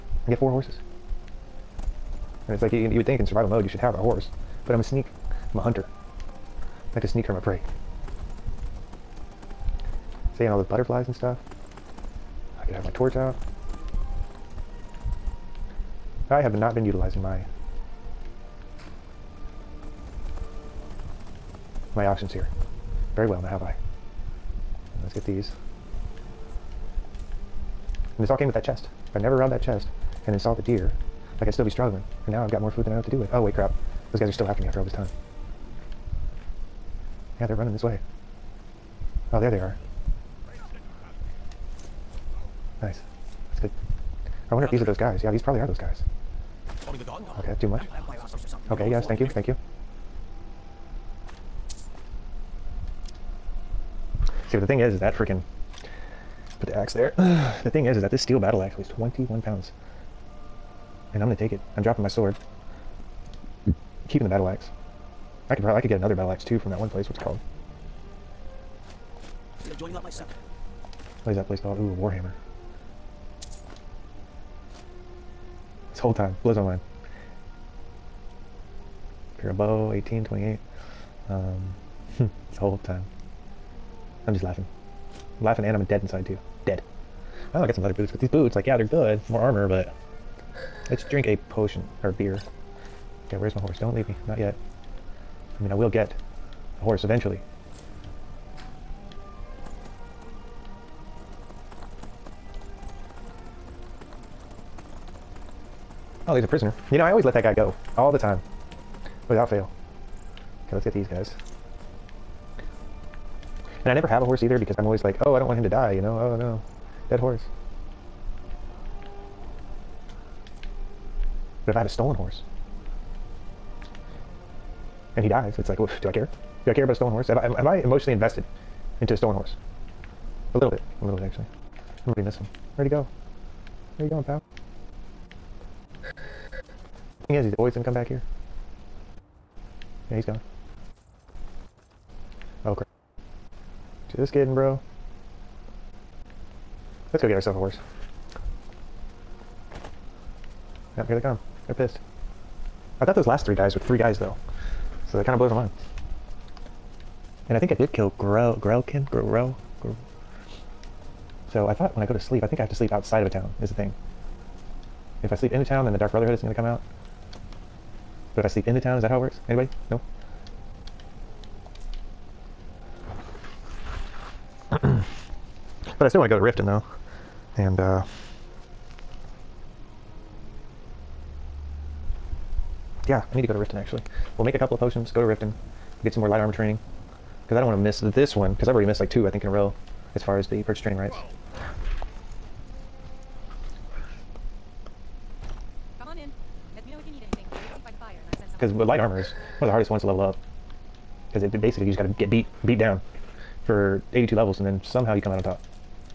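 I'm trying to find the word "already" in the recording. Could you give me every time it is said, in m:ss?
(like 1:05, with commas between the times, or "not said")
2:12, 3:08.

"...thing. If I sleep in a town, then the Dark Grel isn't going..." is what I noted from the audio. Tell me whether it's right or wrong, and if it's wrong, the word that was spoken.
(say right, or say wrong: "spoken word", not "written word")
wrong: "Brotherhood", not "Grel".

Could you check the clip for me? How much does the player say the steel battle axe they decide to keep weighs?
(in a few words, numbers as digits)
21 pounds.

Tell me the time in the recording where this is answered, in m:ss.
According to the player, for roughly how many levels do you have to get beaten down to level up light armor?
3:24.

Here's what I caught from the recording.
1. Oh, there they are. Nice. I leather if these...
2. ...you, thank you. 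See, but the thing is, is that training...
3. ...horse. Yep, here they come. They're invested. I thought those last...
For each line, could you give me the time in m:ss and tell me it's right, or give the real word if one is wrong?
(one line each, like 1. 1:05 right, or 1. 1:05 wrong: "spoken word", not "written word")
1. 0:39 wrong: "wonder", not "leather"
2. 0:49 wrong: "freaking", not "training"
3. 2:27 wrong: "pissed", not "invested".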